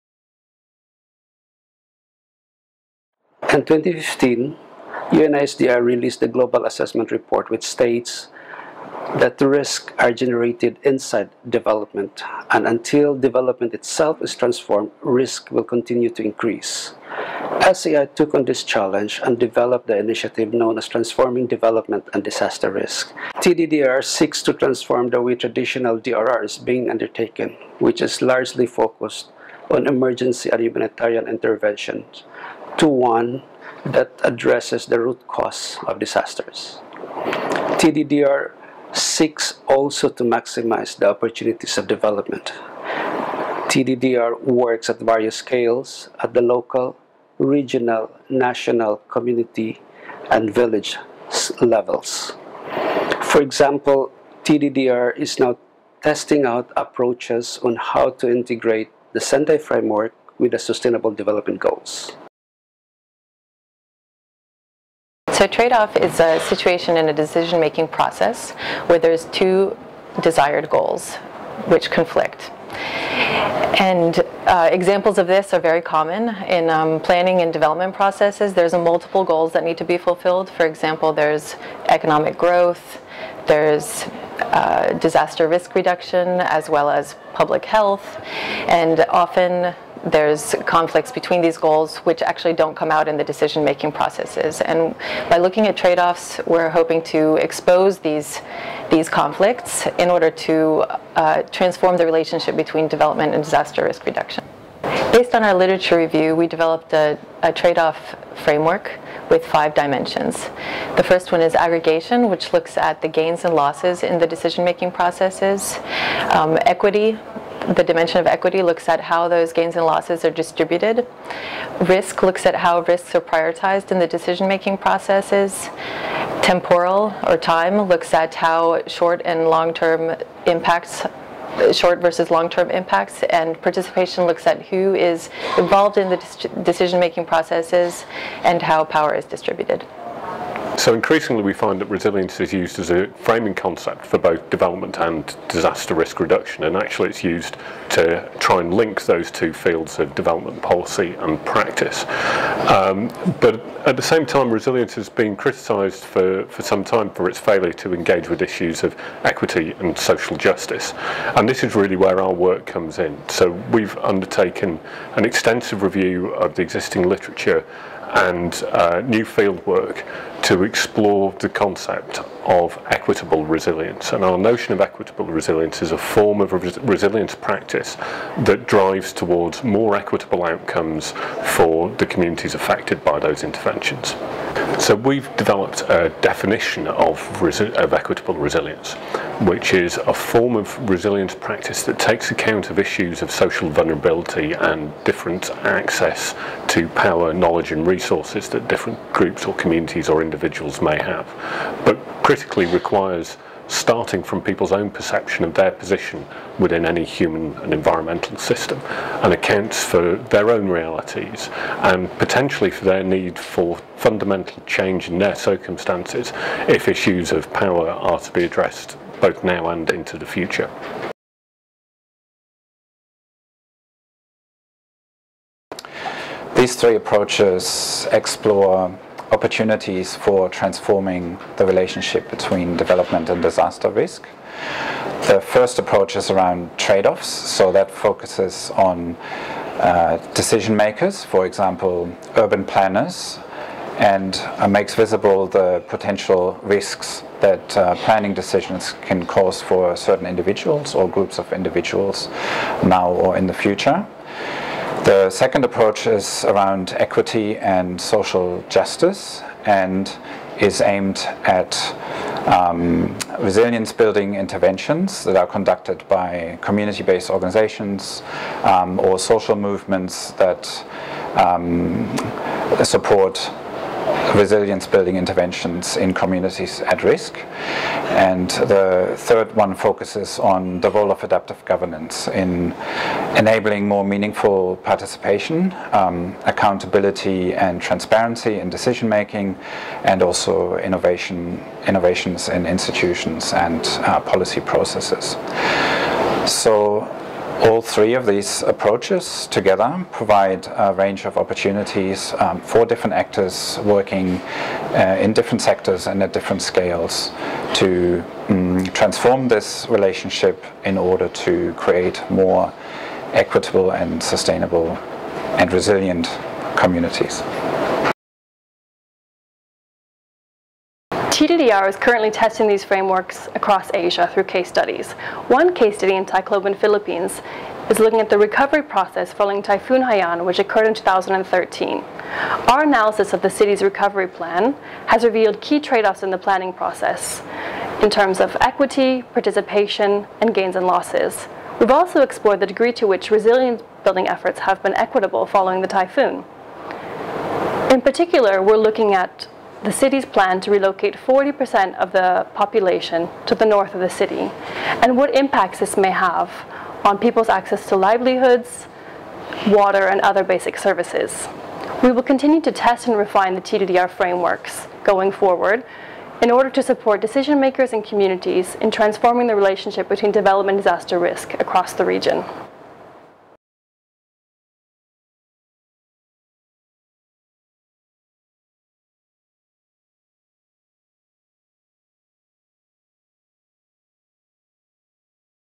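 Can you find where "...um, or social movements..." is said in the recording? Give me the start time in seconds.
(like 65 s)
268 s.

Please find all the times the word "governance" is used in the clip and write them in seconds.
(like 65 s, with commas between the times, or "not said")
281 s.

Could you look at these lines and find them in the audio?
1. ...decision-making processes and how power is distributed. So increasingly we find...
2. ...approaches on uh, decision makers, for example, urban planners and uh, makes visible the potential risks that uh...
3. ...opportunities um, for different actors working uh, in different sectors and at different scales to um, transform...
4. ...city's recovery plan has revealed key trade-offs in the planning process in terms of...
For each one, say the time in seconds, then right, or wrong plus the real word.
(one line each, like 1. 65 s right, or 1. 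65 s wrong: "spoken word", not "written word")
1. 136 s right
2. 237 s wrong: "focuses", not "approaches"
3. 301 s right
4. 333 s right.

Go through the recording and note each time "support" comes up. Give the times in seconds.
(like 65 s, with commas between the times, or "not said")
272 s, 366 s.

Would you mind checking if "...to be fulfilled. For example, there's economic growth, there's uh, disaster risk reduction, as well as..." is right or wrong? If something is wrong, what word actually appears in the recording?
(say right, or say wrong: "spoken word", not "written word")
right.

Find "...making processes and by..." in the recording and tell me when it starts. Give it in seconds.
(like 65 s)
93 s.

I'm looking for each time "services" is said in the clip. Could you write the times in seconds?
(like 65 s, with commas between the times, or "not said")
360 s.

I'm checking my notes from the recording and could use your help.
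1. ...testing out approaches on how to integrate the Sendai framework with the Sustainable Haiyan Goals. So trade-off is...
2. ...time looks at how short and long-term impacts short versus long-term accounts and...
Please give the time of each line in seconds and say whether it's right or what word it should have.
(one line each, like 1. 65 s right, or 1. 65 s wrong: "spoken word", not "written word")
1. 56 s wrong: "Development", not "Haiyan"
2. 127 s wrong: "impacts", not "accounts".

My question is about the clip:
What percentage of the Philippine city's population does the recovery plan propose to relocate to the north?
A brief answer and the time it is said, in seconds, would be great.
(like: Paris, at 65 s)
40%, at 351 s.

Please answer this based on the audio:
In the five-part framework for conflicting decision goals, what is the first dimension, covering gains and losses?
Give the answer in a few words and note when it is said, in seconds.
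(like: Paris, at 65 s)
Aggregation, at 111 s.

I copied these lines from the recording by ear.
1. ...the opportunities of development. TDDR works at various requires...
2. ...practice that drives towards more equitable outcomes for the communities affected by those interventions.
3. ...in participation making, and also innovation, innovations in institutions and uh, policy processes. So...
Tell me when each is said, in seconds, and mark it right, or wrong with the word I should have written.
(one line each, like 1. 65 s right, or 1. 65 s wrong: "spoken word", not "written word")
1. 40 s wrong: "scales", not "requires"
2. 177 s right
3. 288 s wrong: "decision", not "participation".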